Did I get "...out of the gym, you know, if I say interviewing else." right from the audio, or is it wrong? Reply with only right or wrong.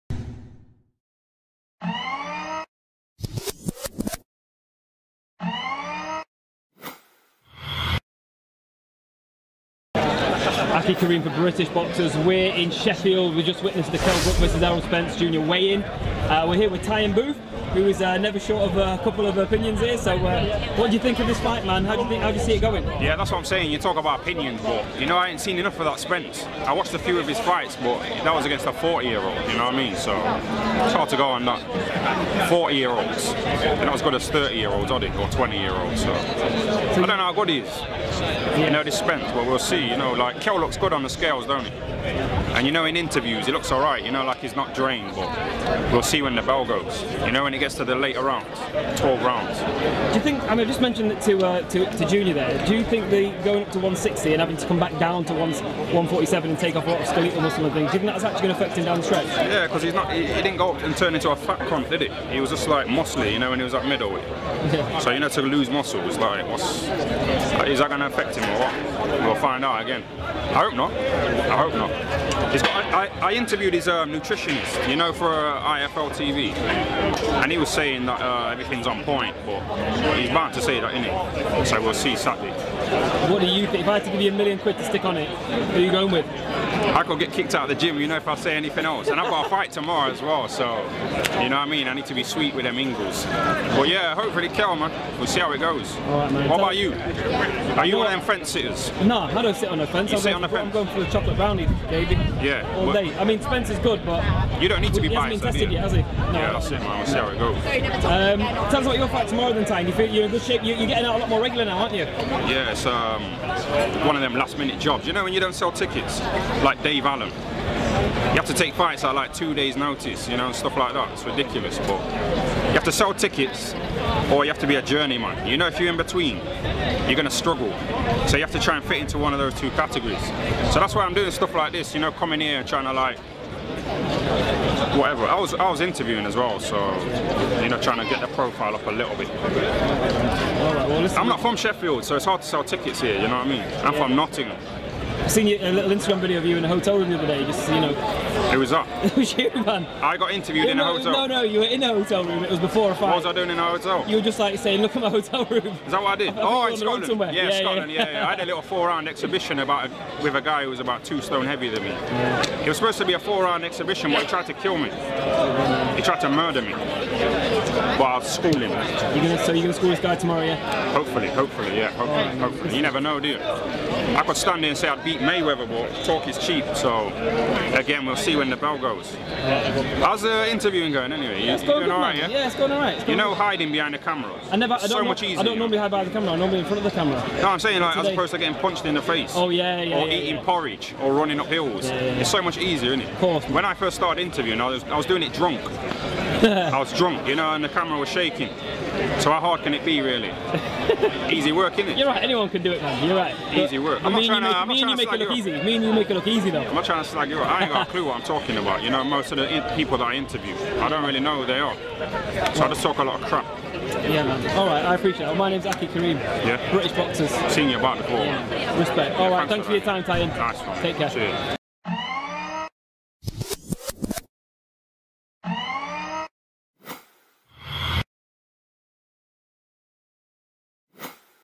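wrong.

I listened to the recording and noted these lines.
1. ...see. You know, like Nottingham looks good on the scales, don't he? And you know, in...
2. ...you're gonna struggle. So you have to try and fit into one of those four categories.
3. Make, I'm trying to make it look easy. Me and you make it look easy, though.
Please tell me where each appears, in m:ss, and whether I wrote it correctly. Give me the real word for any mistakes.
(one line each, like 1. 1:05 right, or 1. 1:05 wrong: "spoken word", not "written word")
1. 0:39 wrong: "Kell", not "Nottingham"
2. 2:07 wrong: "two", not "four"
3. 3:24 right.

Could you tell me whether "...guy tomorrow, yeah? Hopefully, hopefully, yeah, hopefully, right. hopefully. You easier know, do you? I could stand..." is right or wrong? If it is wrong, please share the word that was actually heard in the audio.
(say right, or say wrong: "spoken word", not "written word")
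wrong: "never", not "easier".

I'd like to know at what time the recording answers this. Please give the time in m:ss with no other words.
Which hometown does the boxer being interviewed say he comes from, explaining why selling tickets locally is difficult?
2:24.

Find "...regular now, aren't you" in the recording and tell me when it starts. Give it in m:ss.
1:51.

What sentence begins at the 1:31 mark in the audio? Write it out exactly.
I need to be sweet with them Ingles.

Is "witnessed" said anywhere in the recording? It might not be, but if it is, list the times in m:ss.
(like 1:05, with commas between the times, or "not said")
0:13.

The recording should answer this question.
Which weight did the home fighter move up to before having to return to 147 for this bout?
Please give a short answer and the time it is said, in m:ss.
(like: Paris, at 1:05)
160, at 0:53.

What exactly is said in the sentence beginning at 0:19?
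So, uh, what do you think of this fight, man?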